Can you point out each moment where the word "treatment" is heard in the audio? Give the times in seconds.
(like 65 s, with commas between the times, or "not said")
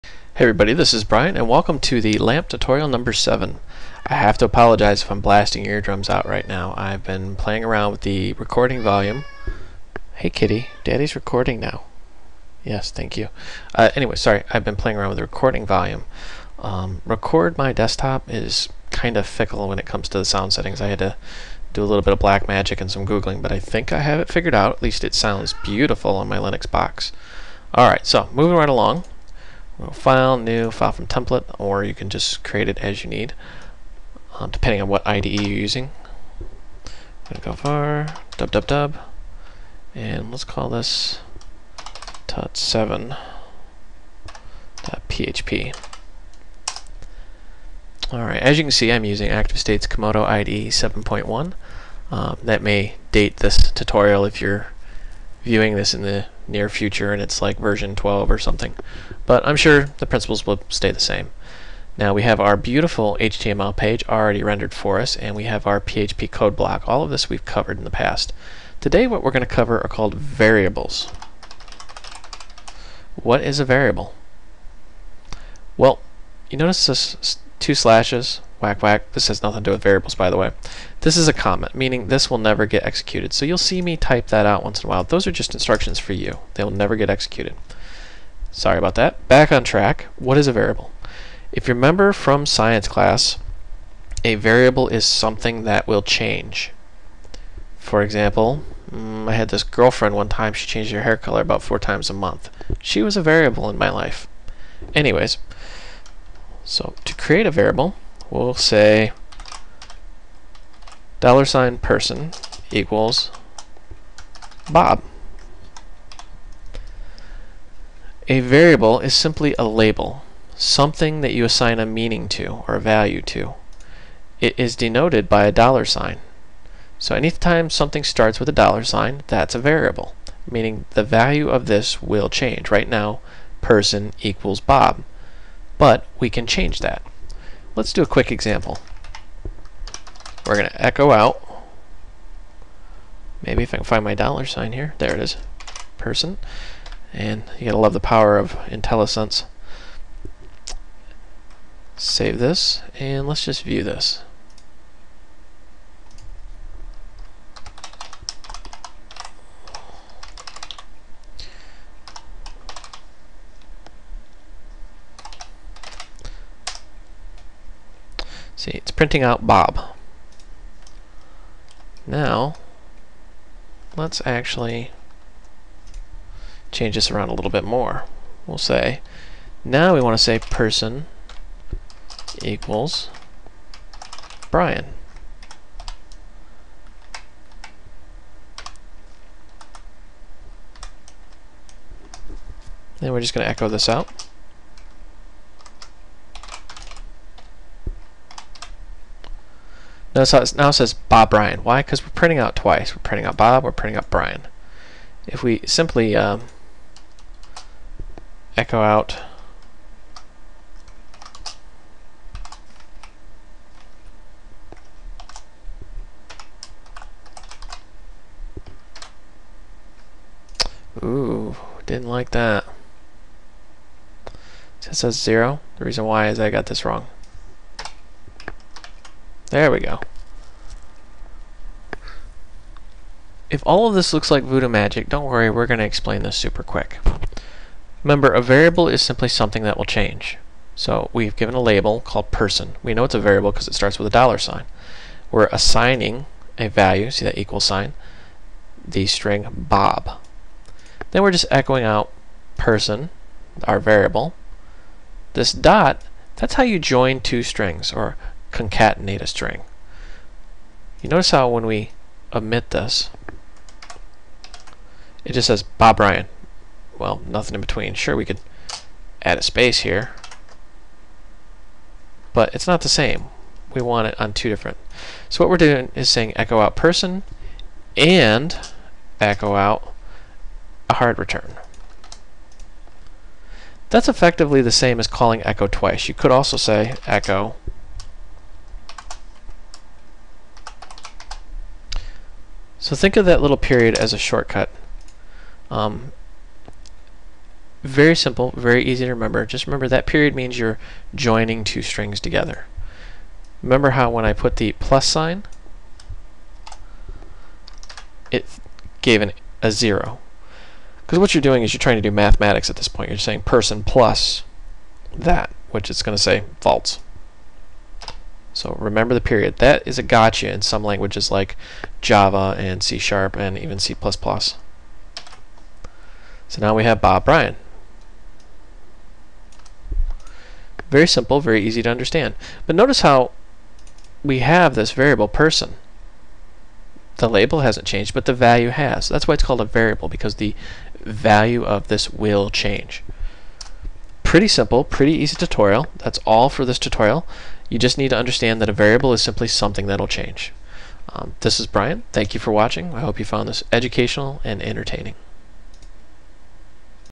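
not said.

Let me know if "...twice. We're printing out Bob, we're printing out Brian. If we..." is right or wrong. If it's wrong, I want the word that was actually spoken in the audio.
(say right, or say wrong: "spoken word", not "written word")
right.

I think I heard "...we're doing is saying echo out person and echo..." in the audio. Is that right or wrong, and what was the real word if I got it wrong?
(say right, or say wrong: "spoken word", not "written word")
right.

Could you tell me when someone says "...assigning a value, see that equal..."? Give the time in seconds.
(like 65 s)
245 s.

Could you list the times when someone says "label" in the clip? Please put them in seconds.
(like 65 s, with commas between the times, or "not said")
119 s, 241 s, 337 s.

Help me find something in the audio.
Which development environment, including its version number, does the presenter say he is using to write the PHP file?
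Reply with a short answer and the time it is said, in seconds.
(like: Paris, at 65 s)
Komodo IDE 7.1, at 49 s.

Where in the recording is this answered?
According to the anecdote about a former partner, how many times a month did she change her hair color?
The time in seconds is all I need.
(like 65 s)
101 s.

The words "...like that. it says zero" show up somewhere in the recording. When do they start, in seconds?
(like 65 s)
222 s.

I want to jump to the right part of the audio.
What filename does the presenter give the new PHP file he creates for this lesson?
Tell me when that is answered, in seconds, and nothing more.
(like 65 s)
42 s.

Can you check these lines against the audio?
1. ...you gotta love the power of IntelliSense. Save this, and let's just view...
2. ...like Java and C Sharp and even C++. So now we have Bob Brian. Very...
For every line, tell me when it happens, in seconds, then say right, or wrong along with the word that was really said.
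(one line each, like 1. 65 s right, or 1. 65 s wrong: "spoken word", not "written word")
1. 147 s right
2. 321 s right.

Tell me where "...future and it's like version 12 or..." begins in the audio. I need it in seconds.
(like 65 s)
56 s.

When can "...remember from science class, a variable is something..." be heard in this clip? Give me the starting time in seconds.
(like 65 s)
91 s.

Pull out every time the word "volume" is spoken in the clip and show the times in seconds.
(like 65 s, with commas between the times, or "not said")
8 s, 15 s.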